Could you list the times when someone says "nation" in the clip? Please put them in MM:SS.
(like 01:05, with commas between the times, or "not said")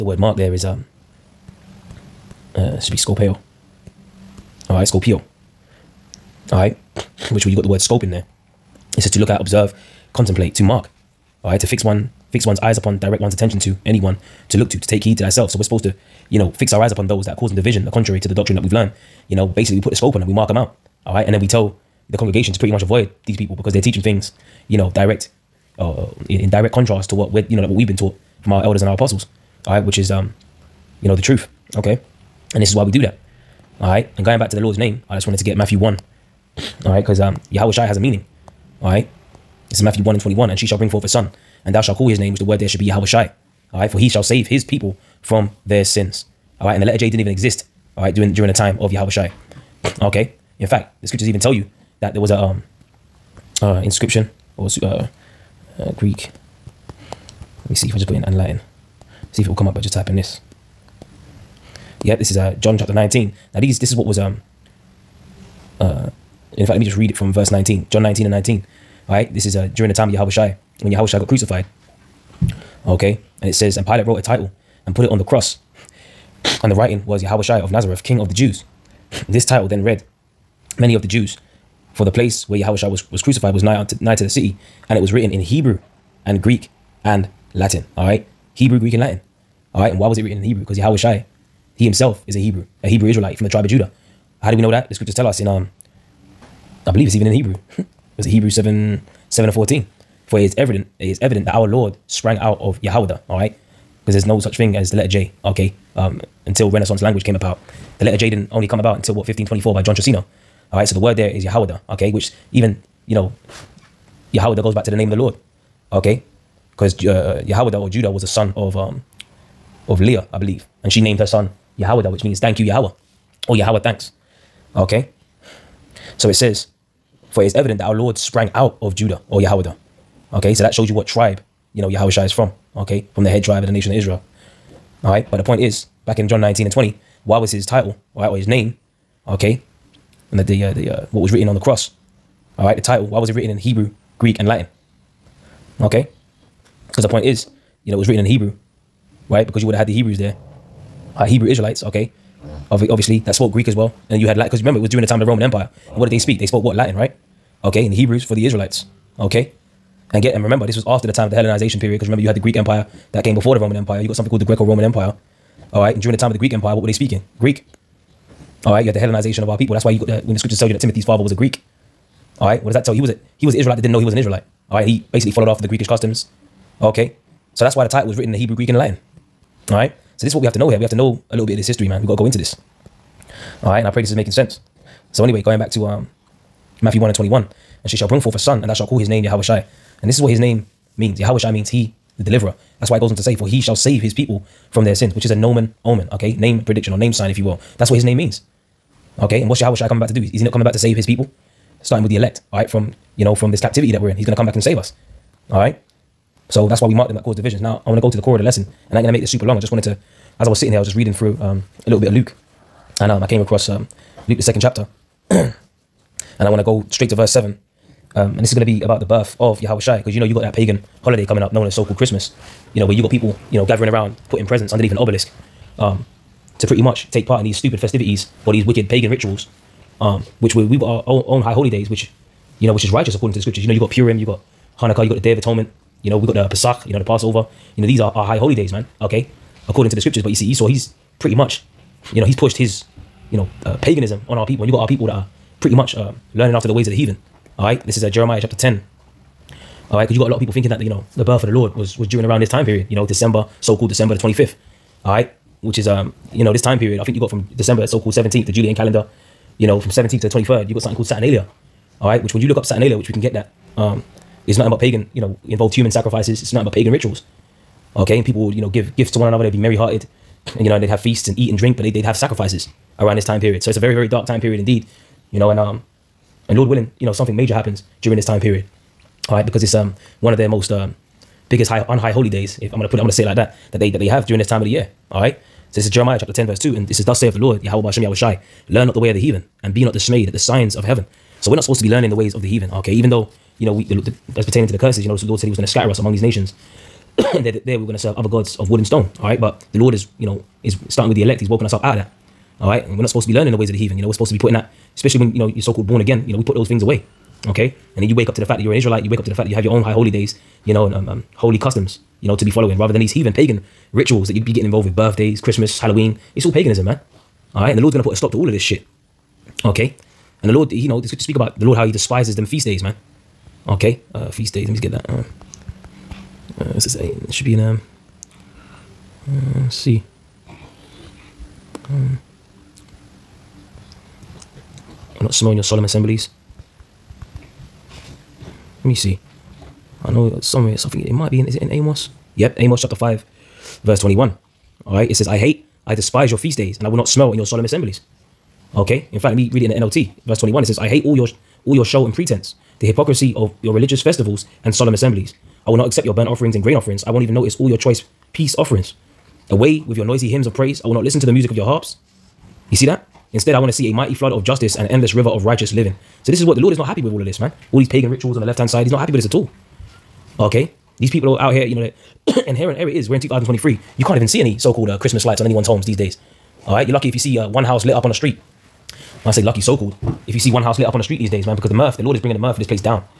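02:13, 04:56.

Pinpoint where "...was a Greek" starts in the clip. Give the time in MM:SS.
02:51.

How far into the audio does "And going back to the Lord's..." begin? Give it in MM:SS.
00:34.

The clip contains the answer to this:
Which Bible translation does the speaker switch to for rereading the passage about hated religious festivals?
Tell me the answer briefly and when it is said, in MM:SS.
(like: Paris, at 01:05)
NLT, at 05:49.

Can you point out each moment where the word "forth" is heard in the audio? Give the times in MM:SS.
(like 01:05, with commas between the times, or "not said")
00:40, 03:08.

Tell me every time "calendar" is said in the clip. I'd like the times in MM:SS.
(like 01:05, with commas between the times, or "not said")
04:18.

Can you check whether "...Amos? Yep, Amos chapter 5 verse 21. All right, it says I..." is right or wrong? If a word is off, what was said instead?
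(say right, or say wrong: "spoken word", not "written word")
right.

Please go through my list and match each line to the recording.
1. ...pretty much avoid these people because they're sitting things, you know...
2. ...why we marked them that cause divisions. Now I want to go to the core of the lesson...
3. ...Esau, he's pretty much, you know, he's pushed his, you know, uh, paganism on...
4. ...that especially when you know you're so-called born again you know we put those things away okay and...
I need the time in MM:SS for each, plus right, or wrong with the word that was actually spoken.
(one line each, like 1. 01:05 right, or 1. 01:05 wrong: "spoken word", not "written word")
1. 00:22 wrong: "teaching", not "sitting"
2. 03:26 right
3. 04:00 right
4. 05:04 right.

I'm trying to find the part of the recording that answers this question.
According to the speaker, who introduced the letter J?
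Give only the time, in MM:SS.
01:49.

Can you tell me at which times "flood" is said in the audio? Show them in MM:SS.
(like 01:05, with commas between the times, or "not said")
06:04.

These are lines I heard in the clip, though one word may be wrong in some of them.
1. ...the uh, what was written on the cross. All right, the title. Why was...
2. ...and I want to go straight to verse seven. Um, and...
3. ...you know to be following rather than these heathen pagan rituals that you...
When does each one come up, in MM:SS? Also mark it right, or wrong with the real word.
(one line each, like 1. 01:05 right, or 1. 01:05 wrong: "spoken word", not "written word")
1. 02:20 right
2. 03:35 right
3. 05:12 right.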